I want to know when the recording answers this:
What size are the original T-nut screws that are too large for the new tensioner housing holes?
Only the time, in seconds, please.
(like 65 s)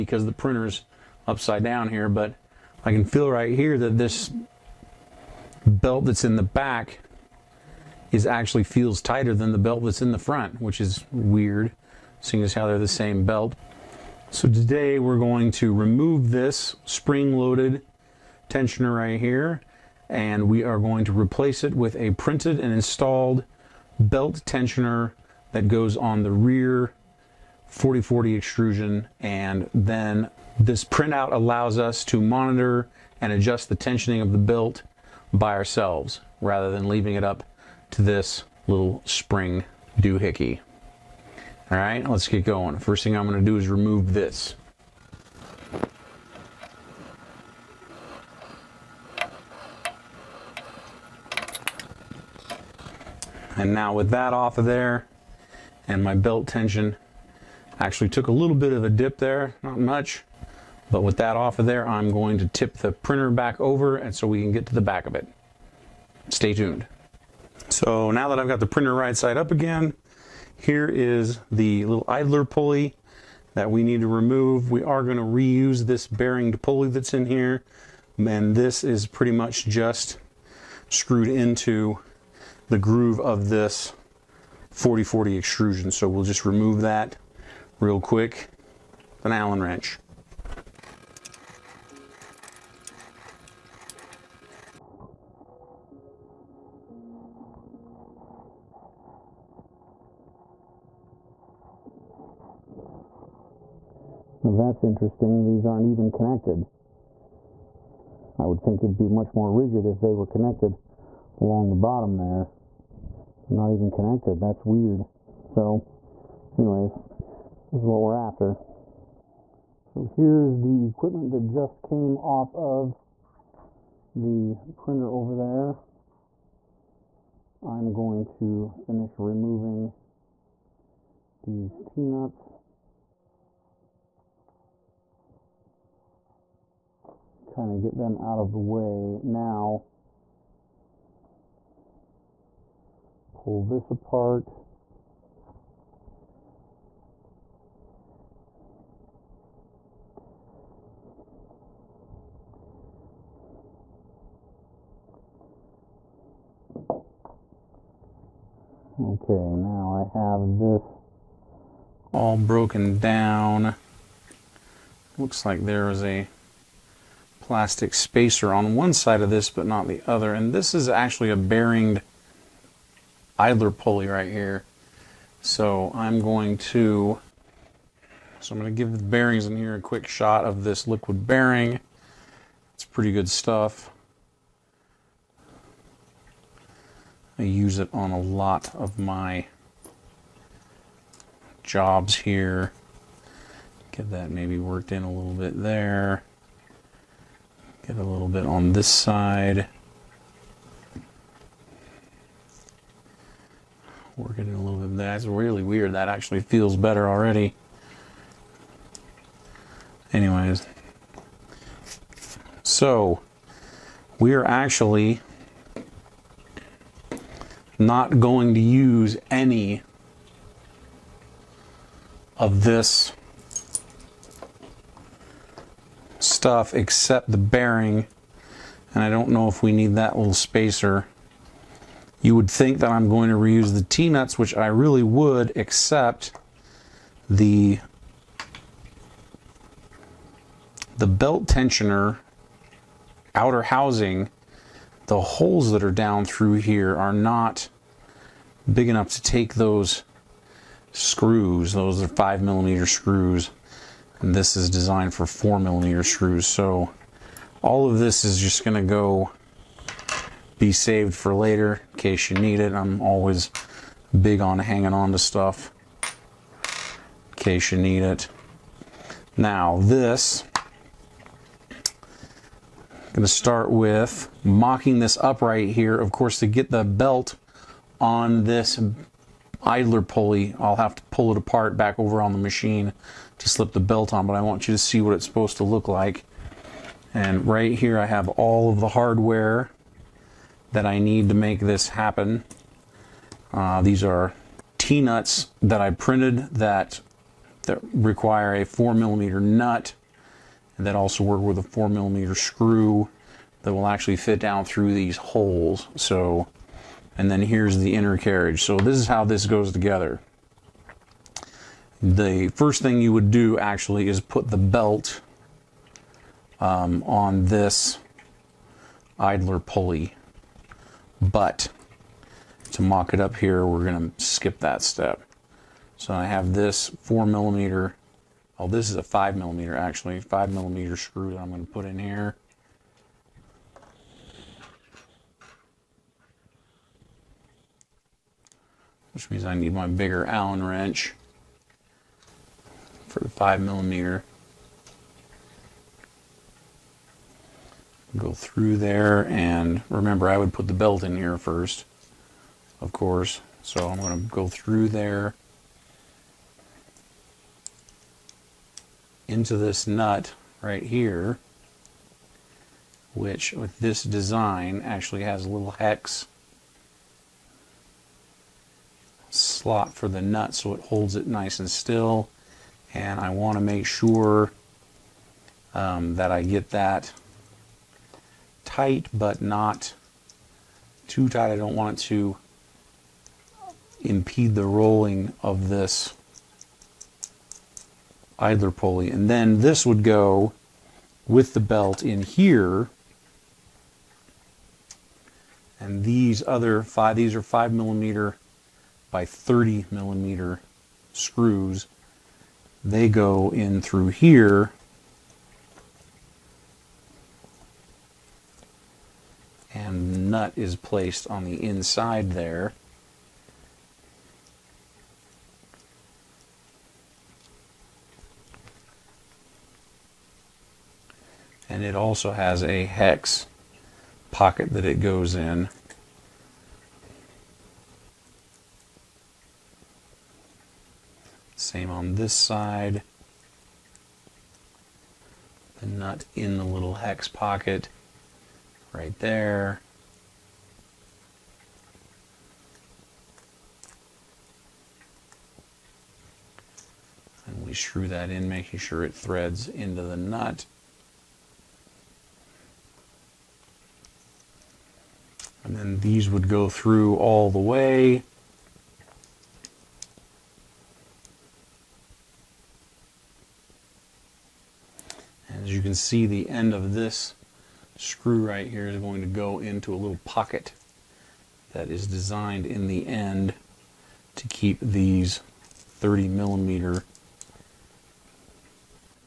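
252 s.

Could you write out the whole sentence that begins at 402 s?
They go in through here and nut is placed on the inside there.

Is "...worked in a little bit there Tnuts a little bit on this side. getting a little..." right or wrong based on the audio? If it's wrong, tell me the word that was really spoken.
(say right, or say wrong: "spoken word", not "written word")
wrong: "Get", not "Tnuts".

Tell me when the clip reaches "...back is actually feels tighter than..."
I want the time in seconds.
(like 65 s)
6 s.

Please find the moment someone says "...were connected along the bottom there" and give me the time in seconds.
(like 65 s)
110 s.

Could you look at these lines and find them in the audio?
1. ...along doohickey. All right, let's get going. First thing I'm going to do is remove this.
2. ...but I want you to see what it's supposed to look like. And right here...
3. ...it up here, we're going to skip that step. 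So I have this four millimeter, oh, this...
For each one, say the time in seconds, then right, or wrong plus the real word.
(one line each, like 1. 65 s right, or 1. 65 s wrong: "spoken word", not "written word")
1. 39 s wrong: "spring", not "along"
2. 284 s right
3. 323 s right.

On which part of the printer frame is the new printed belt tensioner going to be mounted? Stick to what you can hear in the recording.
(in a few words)
Rear 4040 extrusion.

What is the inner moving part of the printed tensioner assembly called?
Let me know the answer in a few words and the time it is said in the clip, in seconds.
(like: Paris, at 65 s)
Inner carriage, at 307 s.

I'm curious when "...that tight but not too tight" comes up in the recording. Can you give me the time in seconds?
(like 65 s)
376 s.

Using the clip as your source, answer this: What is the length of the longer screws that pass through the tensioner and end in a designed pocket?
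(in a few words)
30 millimeter.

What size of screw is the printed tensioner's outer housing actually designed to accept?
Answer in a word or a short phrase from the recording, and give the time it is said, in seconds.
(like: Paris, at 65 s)
4 millimeter, at 255 s.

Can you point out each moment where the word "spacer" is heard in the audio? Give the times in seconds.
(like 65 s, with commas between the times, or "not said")
167 s, 230 s.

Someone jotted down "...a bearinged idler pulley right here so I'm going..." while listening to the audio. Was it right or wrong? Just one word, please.
right.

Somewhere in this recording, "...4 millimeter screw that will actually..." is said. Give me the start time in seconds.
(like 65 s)
301 s.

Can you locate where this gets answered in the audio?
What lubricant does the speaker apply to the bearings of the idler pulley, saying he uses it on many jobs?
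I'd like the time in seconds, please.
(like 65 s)
180 s.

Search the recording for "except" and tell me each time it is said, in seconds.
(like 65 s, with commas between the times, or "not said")
226 s, 235 s.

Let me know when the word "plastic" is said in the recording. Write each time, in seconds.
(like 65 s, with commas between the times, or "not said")
167 s.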